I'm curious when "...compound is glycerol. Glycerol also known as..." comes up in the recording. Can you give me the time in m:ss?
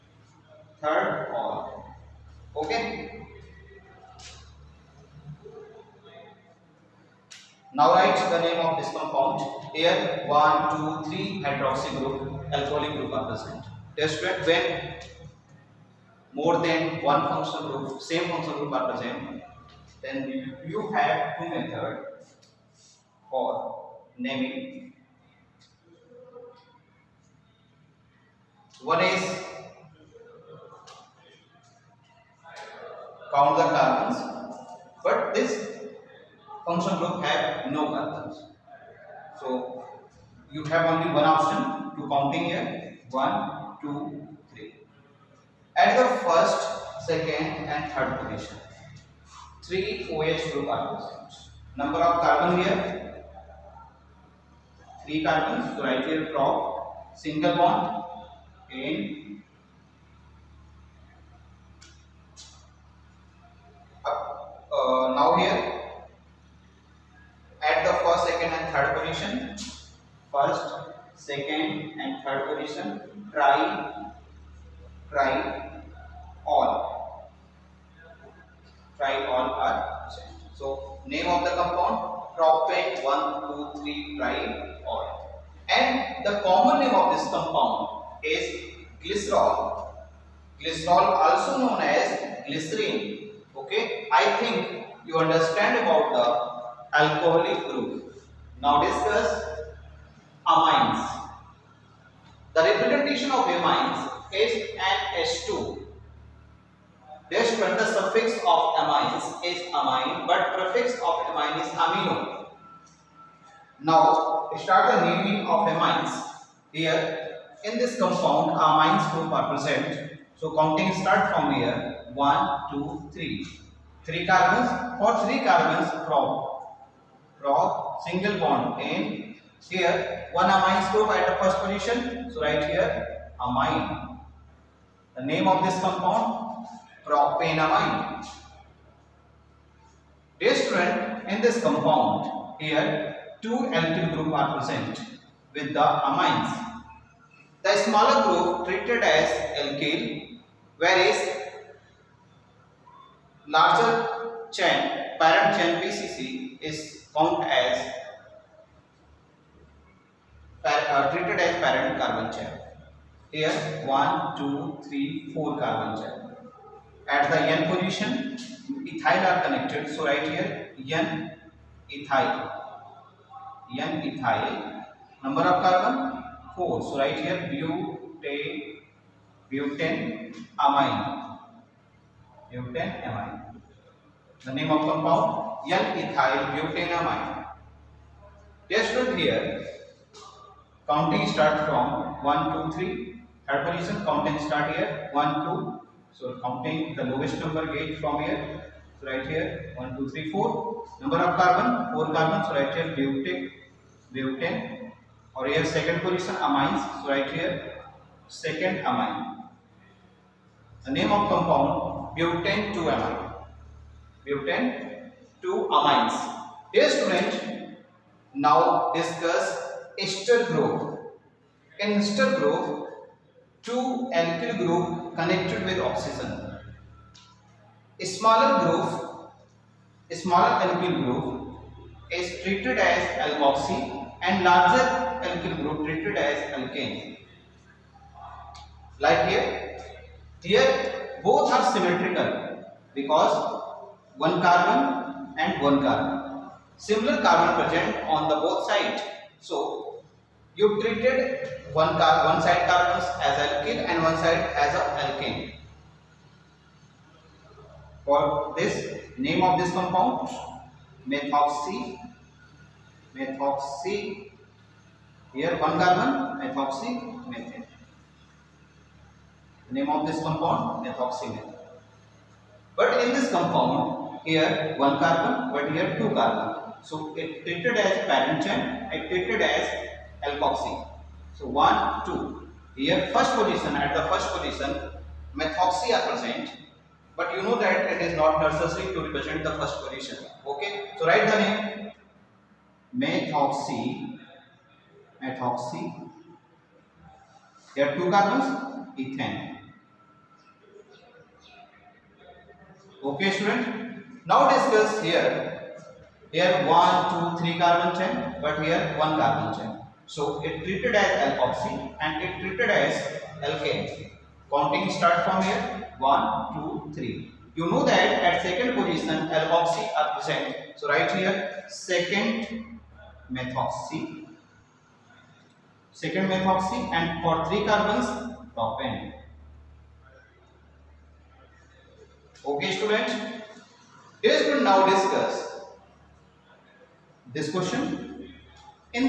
1:27.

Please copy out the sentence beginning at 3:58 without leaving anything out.
Like here, here both are symmetrical because one carbon and one carbon.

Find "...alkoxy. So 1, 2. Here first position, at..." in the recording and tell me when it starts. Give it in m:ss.
4:40.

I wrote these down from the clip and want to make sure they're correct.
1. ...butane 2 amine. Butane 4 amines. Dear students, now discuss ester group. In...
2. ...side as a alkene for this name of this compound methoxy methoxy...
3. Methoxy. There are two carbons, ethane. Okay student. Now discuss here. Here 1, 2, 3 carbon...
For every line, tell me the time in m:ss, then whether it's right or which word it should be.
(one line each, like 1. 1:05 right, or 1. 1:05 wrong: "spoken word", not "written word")
1. 3:32 wrong: "2", not "4"
2. 4:14 right
3. 4:55 right.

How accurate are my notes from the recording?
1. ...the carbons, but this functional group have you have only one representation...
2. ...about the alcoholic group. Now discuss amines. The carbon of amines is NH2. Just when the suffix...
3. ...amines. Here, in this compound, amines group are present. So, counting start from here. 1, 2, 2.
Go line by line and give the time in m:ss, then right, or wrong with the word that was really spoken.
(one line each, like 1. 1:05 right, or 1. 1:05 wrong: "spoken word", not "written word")
1. 0:33 wrong: "option", not "representation"
2. 1:35 wrong: "representation", not "carbon"
3. 1:55 wrong: "3", not "2".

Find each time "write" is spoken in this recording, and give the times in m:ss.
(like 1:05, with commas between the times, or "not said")
0:07, 4:51.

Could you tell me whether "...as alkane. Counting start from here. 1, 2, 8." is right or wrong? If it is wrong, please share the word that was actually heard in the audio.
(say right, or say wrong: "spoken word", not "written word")
wrong: "3", not "8".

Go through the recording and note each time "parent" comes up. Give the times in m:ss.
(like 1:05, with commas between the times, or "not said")
2:35, 2:41, 4:38.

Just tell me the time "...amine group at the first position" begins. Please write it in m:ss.
2:10.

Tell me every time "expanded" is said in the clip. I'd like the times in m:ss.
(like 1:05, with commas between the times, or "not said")
not said.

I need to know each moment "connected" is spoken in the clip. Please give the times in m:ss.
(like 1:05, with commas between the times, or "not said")
2:49, 3:45.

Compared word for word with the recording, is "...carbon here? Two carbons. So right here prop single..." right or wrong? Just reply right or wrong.
wrong.